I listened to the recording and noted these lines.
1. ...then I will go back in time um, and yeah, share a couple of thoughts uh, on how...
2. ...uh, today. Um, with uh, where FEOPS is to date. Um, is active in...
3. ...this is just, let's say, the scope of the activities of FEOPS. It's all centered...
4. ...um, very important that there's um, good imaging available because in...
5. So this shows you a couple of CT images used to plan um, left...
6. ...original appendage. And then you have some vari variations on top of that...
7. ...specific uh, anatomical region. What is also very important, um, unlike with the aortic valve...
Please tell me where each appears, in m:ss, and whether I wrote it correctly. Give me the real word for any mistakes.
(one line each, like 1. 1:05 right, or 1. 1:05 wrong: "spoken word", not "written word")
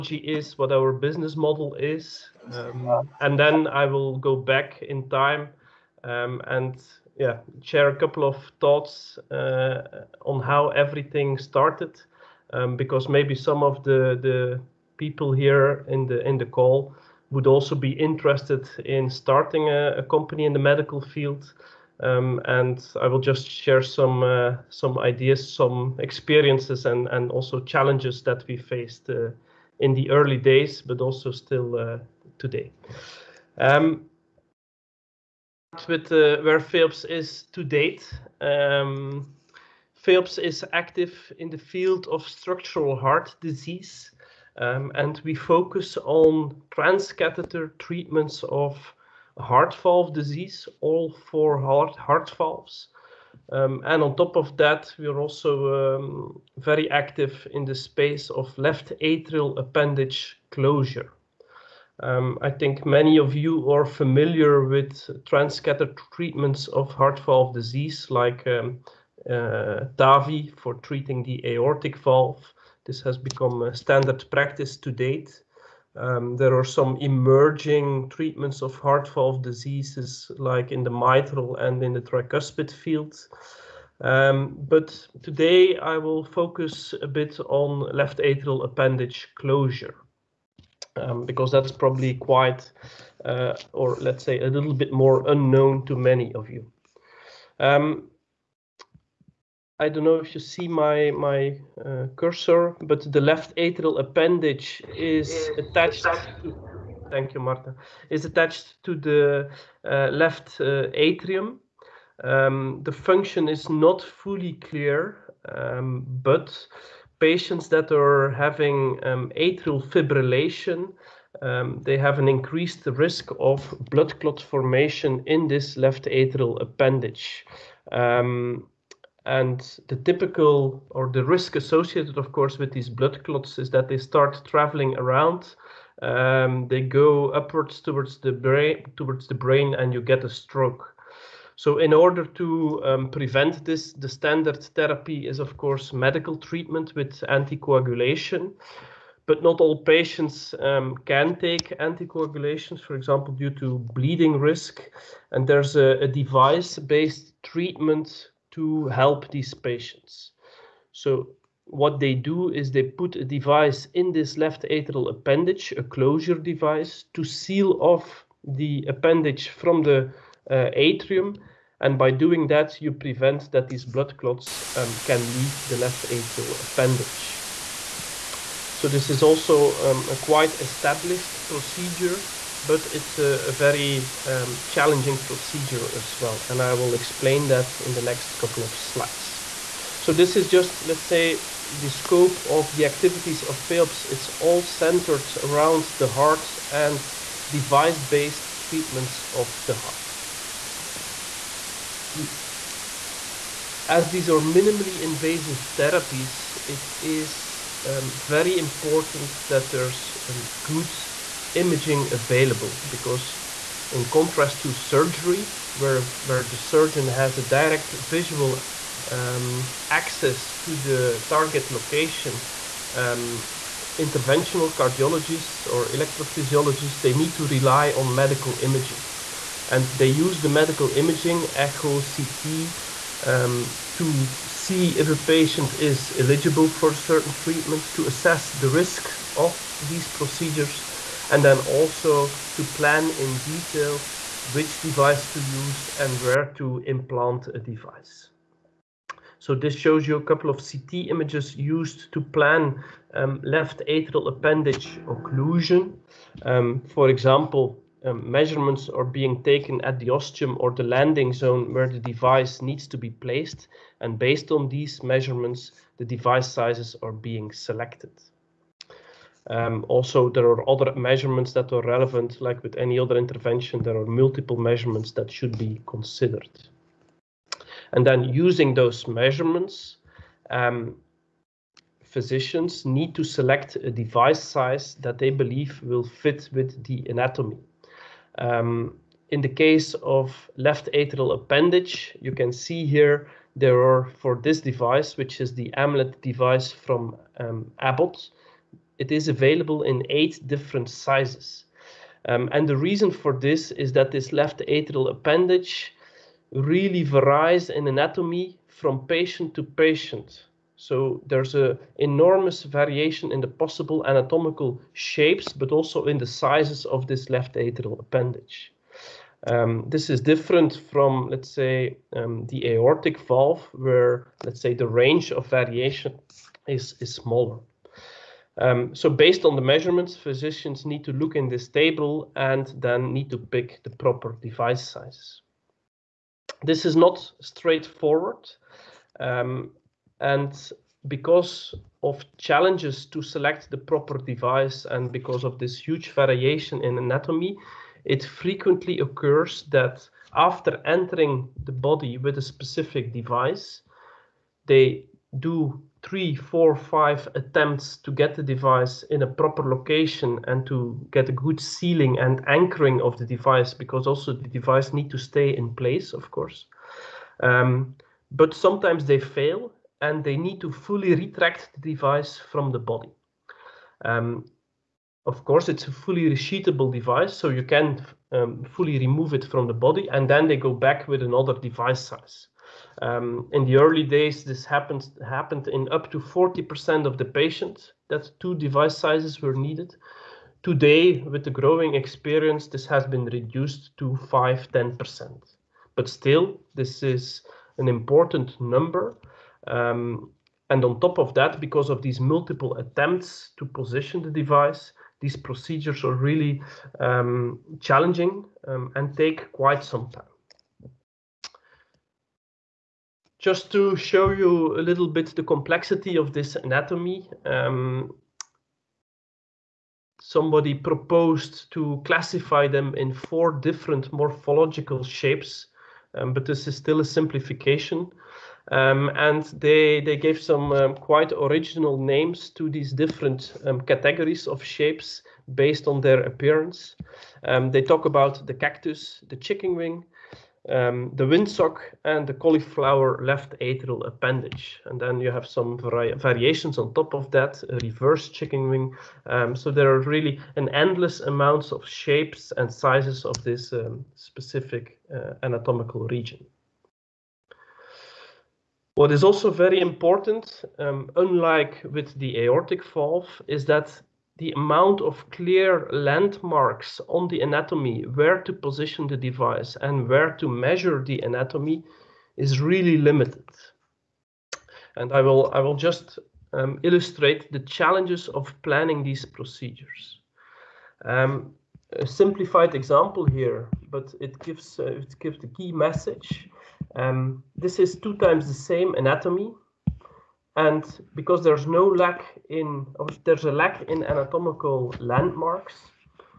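1. 0:03 right
2. 0:31 right
3. 3:10 right
4. 3:27 right
5. 4:09 right
6. 7:23 wrong: "atrial", not "original"
7. 7:34 right.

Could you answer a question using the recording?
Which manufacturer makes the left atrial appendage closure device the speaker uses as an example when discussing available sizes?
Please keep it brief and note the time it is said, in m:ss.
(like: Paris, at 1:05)
Abbott, at 4:57.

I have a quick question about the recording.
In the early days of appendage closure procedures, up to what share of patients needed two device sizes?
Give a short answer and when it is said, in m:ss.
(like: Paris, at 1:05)
40%, at 6:26.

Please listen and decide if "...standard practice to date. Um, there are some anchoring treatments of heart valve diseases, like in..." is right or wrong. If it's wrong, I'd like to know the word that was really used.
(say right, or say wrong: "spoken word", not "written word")
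wrong: "emerging", not "anchoring".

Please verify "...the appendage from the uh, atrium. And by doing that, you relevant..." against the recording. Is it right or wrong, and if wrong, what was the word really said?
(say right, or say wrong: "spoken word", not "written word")
wrong: "prevent", not "relevant".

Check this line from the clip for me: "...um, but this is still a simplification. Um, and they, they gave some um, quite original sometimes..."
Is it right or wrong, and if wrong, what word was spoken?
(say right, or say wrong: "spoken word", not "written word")
wrong: "names", not "sometimes".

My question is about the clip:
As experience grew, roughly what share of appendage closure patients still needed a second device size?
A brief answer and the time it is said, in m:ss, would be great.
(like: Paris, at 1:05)
5-10%, at 6:34.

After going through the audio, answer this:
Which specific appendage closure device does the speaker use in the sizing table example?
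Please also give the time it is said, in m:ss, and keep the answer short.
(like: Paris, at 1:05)
Amulet, at 4:55.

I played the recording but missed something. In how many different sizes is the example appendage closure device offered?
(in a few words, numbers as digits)
8.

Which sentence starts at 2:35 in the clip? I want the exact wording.
And there's a, a device based treatment to help these patients.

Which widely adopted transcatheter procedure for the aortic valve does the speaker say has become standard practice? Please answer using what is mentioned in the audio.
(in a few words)
TAVI.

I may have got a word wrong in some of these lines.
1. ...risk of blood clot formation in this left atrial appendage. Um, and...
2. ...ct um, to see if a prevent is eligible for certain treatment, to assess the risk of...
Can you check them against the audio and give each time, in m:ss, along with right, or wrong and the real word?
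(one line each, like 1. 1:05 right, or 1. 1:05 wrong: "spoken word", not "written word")
1. 2:02 right
2. 3:52 wrong: "patient", not "prevent".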